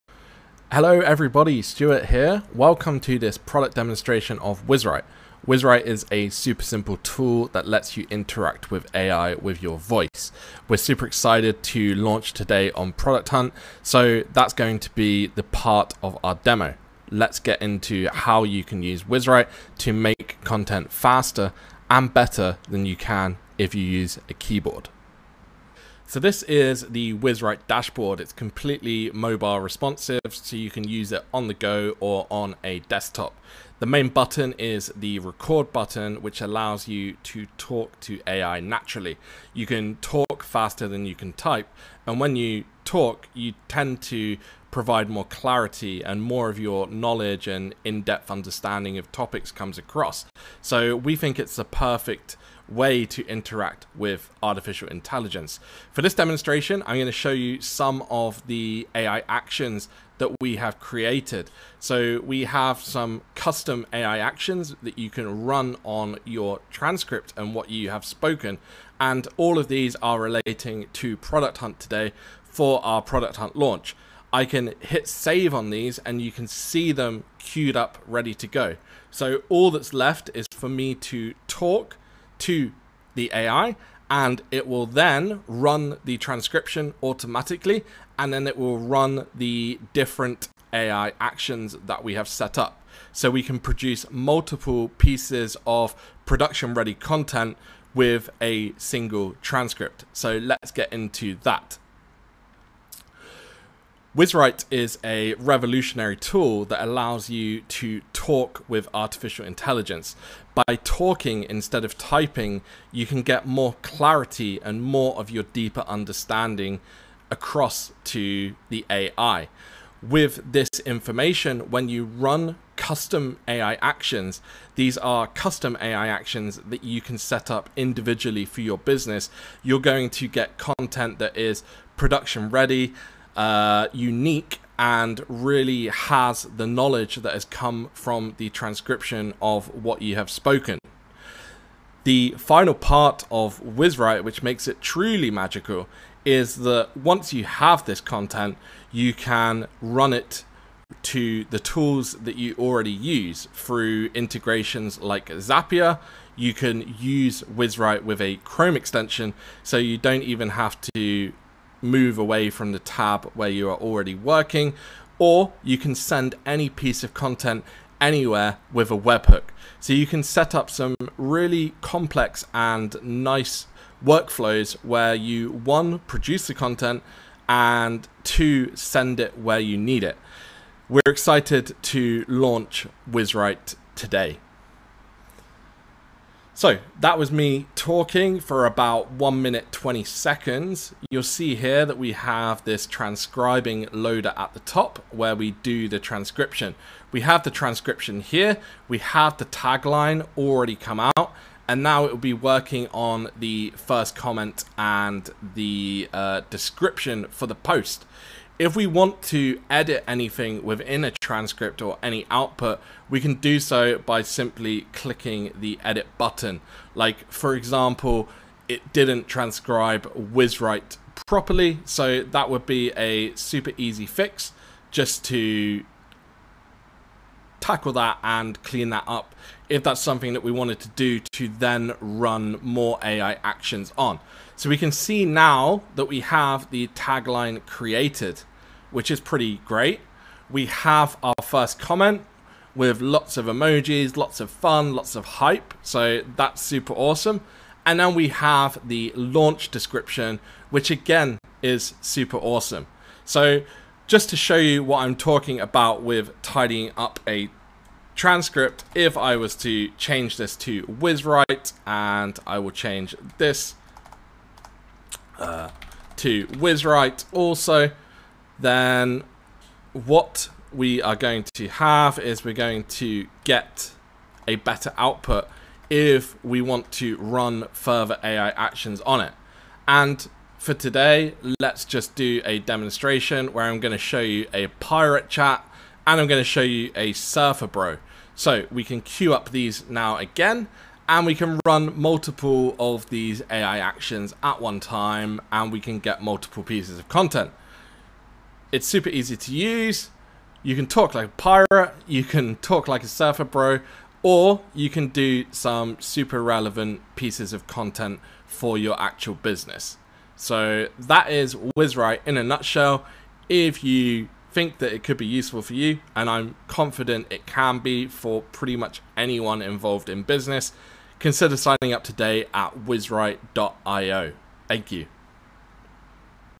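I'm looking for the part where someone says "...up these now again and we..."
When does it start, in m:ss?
4:49.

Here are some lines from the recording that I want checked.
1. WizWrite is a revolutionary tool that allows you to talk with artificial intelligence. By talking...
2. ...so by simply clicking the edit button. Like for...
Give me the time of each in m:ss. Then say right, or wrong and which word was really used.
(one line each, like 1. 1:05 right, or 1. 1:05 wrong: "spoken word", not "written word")
1. 1:44 right
2. 3:33 right.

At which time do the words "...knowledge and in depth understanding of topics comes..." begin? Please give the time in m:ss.
0:46.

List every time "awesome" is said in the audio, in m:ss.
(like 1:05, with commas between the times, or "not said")
4:06, 4:12.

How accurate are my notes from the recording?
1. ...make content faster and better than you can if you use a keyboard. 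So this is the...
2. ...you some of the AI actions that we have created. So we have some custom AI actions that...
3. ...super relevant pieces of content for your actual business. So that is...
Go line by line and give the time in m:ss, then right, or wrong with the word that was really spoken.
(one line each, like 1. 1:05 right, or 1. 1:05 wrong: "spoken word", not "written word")
1. 0:19 right
2. 0:57 right
3. 5:06 right.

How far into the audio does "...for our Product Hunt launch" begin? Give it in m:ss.
1:12.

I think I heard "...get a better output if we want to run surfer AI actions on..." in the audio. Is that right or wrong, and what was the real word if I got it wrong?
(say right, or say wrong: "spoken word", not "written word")
wrong: "further", not "surfer".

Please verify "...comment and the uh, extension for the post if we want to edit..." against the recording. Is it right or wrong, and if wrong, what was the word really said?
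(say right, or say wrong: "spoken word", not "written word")
wrong: "description", not "extension".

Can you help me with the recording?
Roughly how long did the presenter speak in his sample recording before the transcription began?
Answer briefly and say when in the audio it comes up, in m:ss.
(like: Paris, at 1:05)
1 minute 20 seconds, at 3:09.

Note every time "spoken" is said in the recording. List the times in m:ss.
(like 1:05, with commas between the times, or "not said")
1:08, 2:20.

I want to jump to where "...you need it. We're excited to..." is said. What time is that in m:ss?
2:59.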